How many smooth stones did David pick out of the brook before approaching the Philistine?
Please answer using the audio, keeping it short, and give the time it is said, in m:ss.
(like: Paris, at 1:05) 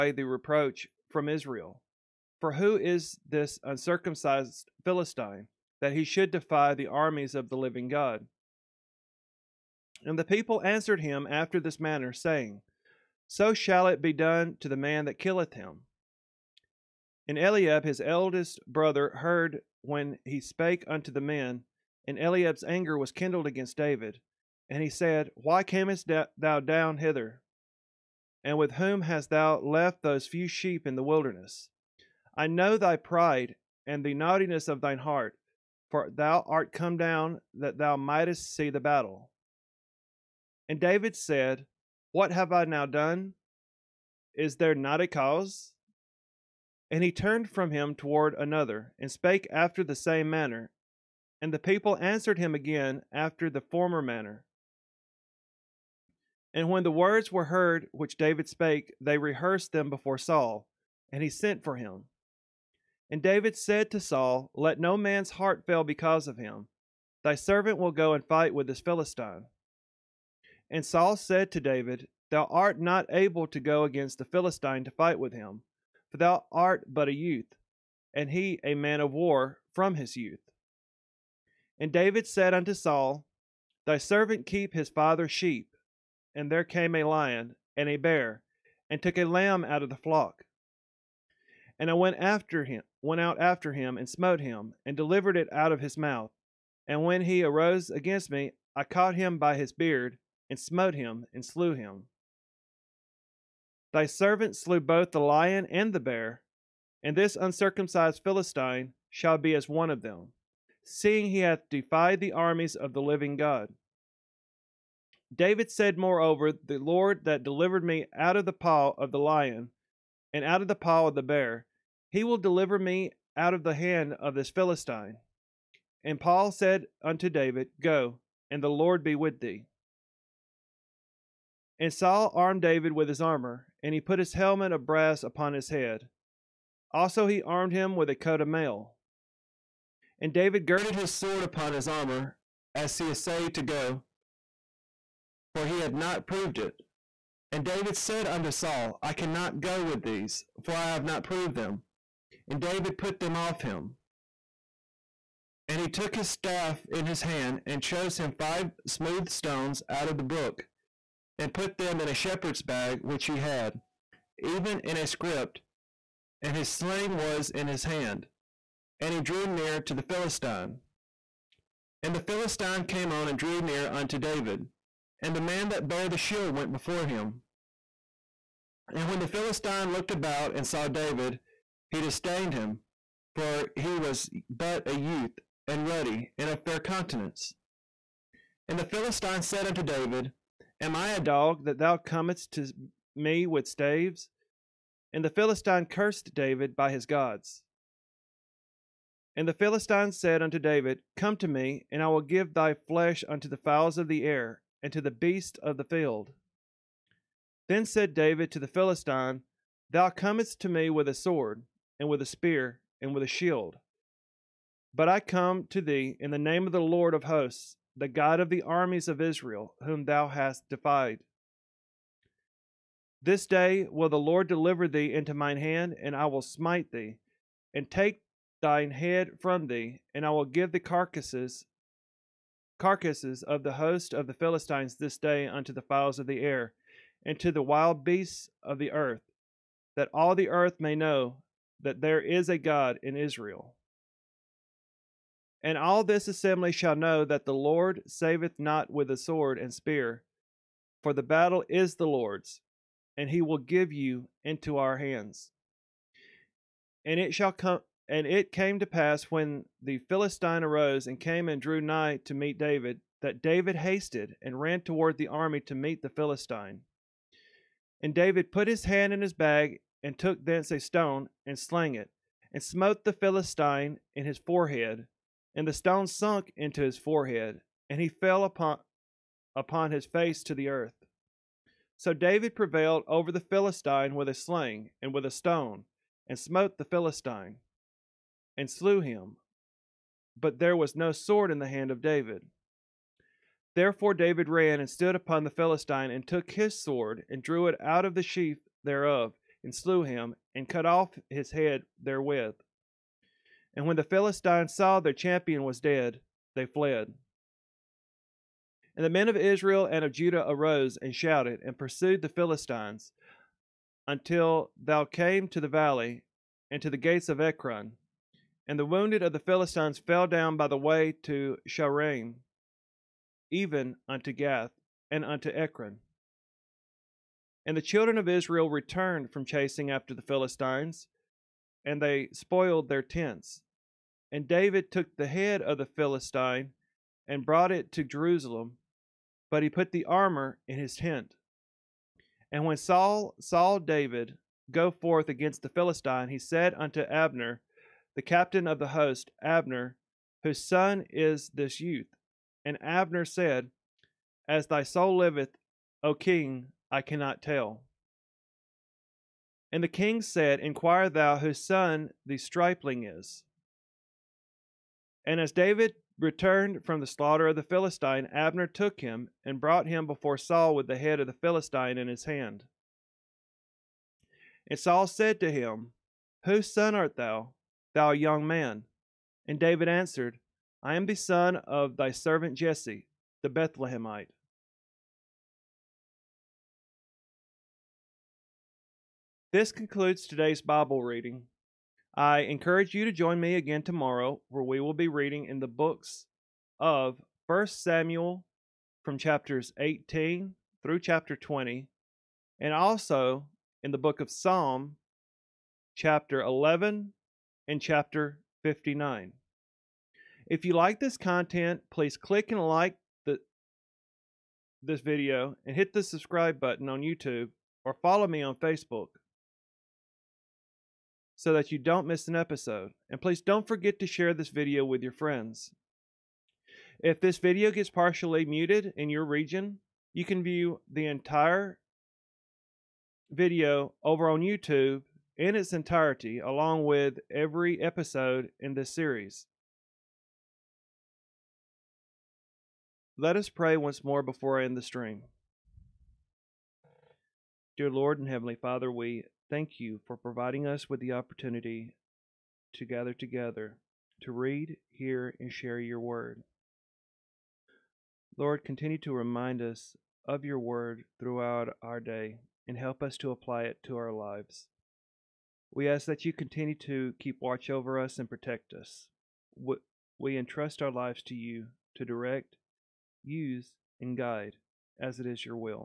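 5, at 2:38.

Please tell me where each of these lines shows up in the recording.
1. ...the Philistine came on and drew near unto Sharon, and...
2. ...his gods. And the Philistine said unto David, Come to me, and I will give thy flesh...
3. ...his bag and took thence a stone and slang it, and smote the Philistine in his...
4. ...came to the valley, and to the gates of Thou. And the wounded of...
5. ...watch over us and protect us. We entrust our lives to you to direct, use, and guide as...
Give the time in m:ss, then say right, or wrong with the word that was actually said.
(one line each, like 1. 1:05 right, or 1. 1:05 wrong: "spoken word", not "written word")
1. 2:52 wrong: "David", not "Sharon"
2. 3:16 right
3. 4:29 right
4. 5:15 wrong: "Ekron", not "Thou"
5. 7:47 right.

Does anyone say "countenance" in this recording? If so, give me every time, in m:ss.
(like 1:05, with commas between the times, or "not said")
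3:06.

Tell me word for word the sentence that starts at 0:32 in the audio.
I know thy pride and the naughtiness of thine heart, for thou art come down that thou mightest see the battle.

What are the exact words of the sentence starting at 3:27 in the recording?
Then said David to the Philistine, Thou comest to me with a sword, and with a spear, and with a shield.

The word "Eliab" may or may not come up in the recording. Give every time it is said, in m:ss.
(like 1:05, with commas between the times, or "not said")
0:17, 0:22.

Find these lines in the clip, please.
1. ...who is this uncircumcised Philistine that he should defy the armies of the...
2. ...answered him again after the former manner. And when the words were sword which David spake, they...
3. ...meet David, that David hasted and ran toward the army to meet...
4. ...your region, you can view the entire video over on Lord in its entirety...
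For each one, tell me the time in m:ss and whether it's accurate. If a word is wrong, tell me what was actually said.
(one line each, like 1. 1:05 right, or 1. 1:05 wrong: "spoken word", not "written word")
1. 0:02 right
2. 0:51 wrong: "heard", not "sword"
3. 4:22 right
4. 7:09 wrong: "YouTube", not "Lord".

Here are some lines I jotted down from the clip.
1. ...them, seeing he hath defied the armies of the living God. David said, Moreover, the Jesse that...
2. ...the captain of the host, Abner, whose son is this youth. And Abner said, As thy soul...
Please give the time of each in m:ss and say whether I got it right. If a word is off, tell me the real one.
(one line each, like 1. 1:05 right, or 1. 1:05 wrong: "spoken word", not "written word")
1. 1:50 wrong: "Lord", not "Jesse"
2. 5:48 right.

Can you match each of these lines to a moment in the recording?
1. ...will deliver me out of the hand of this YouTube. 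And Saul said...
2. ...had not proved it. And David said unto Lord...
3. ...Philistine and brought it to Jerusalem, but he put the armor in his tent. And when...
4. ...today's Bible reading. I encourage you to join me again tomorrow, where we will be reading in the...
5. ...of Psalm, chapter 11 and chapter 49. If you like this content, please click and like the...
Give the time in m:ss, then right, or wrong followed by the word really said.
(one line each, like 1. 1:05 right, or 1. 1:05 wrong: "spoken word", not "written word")
1. 2:02 wrong: "Philistine", not "YouTube"
2. 2:25 wrong: "Saul", not "Lord"
3. 5:35 right
4. 6:30 right
5. 6:44 wrong: "59", not "49".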